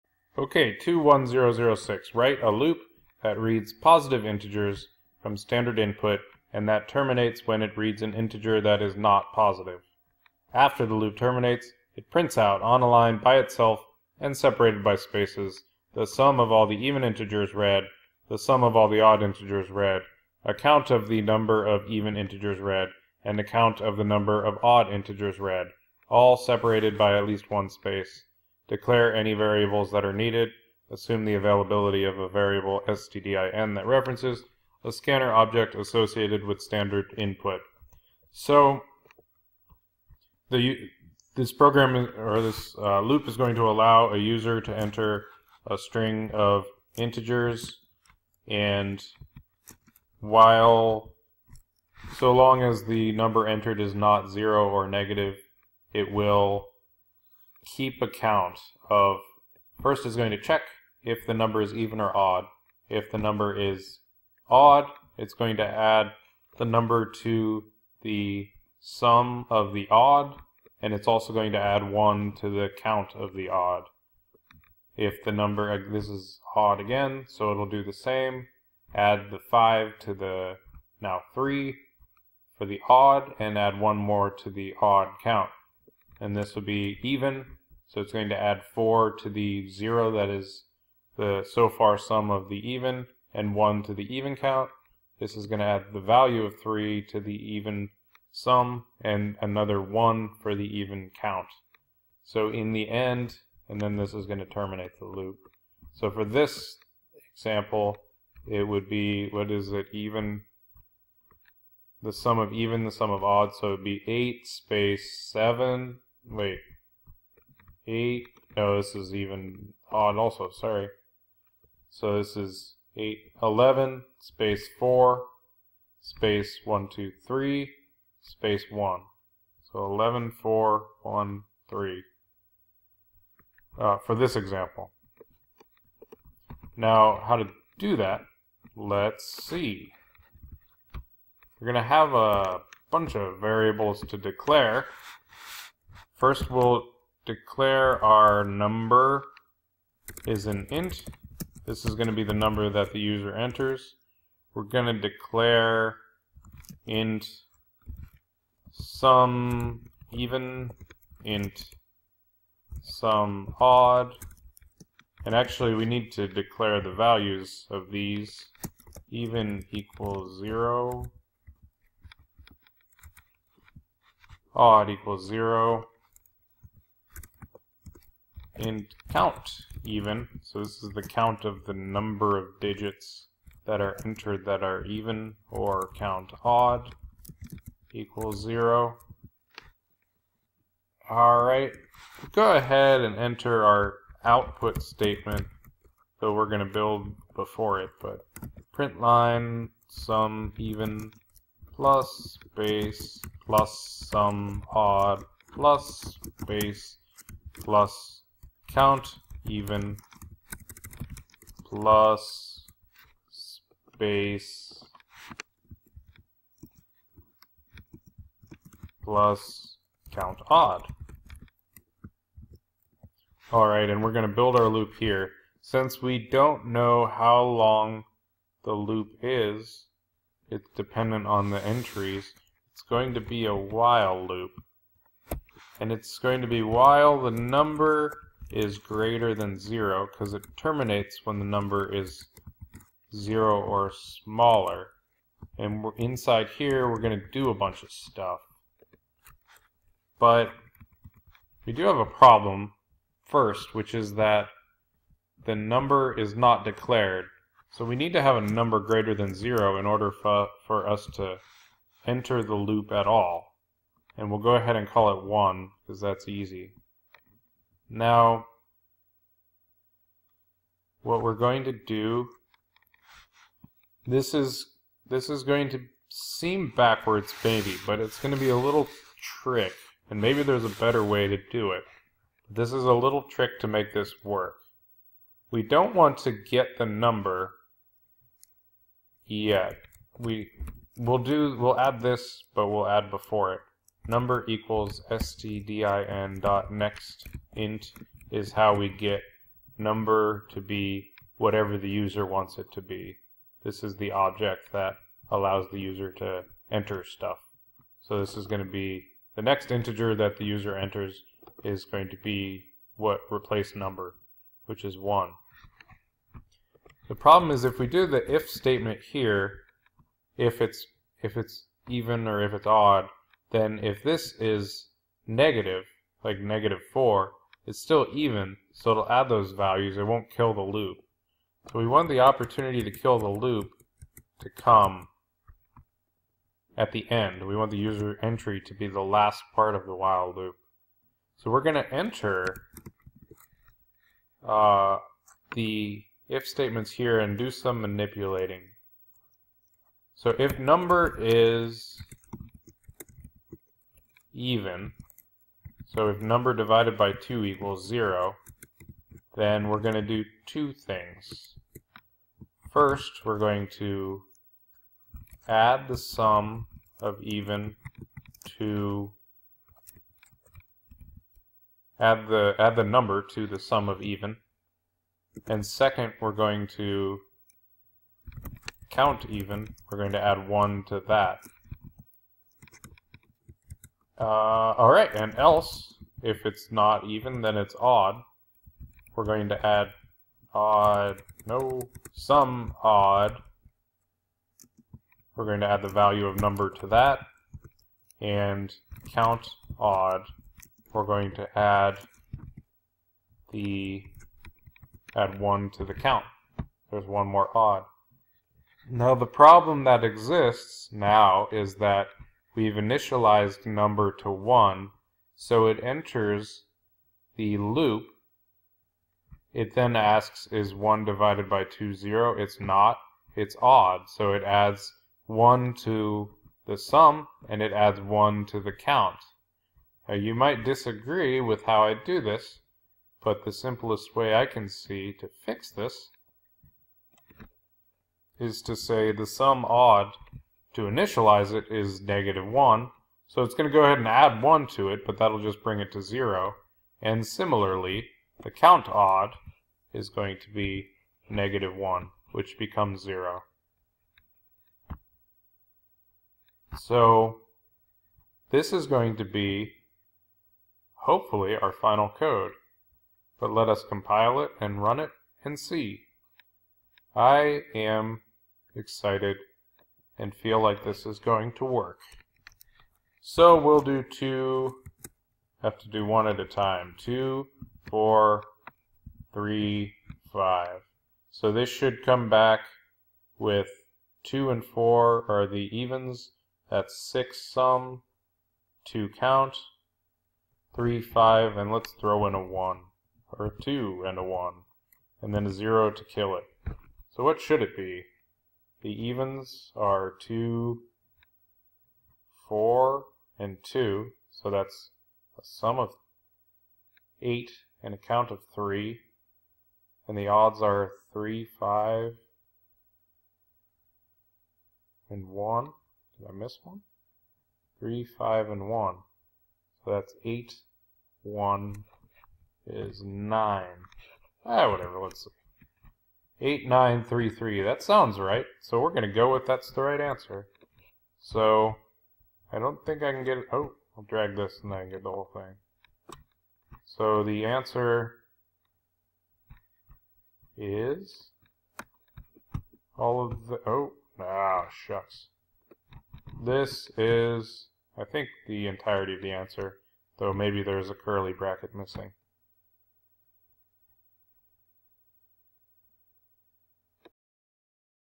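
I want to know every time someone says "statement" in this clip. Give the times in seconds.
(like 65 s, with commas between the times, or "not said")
194 s, 318 s, 346 s.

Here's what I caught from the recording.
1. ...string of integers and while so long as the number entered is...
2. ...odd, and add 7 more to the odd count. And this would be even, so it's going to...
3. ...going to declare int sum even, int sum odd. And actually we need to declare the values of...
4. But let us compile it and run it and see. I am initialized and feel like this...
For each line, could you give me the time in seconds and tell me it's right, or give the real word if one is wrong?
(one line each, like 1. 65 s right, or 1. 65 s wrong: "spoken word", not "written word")
1. 45 s right
2. 82 s wrong: "1", not "7"
3. 154 s right
4. 463 s wrong: "excited", not "initialized".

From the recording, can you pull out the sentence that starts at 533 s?
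Oh, I'll drag this and I get the whole thing.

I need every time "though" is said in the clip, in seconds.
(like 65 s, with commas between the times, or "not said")
196 s, 550 s.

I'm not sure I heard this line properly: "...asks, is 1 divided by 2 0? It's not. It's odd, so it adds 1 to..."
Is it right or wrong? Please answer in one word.
right.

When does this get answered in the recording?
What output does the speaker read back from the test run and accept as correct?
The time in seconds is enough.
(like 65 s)
526 s.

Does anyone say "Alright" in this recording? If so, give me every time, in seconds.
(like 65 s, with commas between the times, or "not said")
191 s, 223 s.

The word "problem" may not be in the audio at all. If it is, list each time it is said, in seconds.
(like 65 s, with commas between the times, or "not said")
252 s, 317 s, 409 s.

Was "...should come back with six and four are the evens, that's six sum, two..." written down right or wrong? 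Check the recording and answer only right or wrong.
wrong.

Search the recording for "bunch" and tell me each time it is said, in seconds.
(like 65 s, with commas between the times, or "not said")
142 s, 247 s.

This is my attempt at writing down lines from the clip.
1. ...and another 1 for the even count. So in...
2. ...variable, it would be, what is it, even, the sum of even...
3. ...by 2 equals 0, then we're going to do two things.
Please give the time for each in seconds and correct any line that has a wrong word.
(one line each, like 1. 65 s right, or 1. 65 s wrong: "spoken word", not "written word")
1. 99 s right
2. 107 s wrong: "example", not "variable"
3. 356 s right.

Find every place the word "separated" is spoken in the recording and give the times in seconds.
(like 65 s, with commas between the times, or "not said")
14 s, 26 s.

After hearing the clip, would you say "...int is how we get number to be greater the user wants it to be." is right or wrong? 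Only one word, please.
wrong.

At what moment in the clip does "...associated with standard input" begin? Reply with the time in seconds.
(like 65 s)
35 s.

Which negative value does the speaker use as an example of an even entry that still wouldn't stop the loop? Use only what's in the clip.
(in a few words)
-4.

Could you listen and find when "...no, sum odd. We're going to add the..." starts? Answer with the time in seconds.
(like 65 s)
391 s.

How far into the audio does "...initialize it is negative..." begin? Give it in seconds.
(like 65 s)
440 s.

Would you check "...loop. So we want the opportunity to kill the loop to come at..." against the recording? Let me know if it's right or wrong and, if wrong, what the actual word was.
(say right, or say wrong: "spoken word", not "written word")
right.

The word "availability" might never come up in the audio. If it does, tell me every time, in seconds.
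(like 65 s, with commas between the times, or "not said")
31 s.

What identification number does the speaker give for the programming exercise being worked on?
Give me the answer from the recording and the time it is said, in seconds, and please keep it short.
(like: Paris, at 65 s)
21006, at 0 s.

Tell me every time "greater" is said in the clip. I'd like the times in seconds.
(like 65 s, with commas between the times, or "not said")
238 s, 258 s.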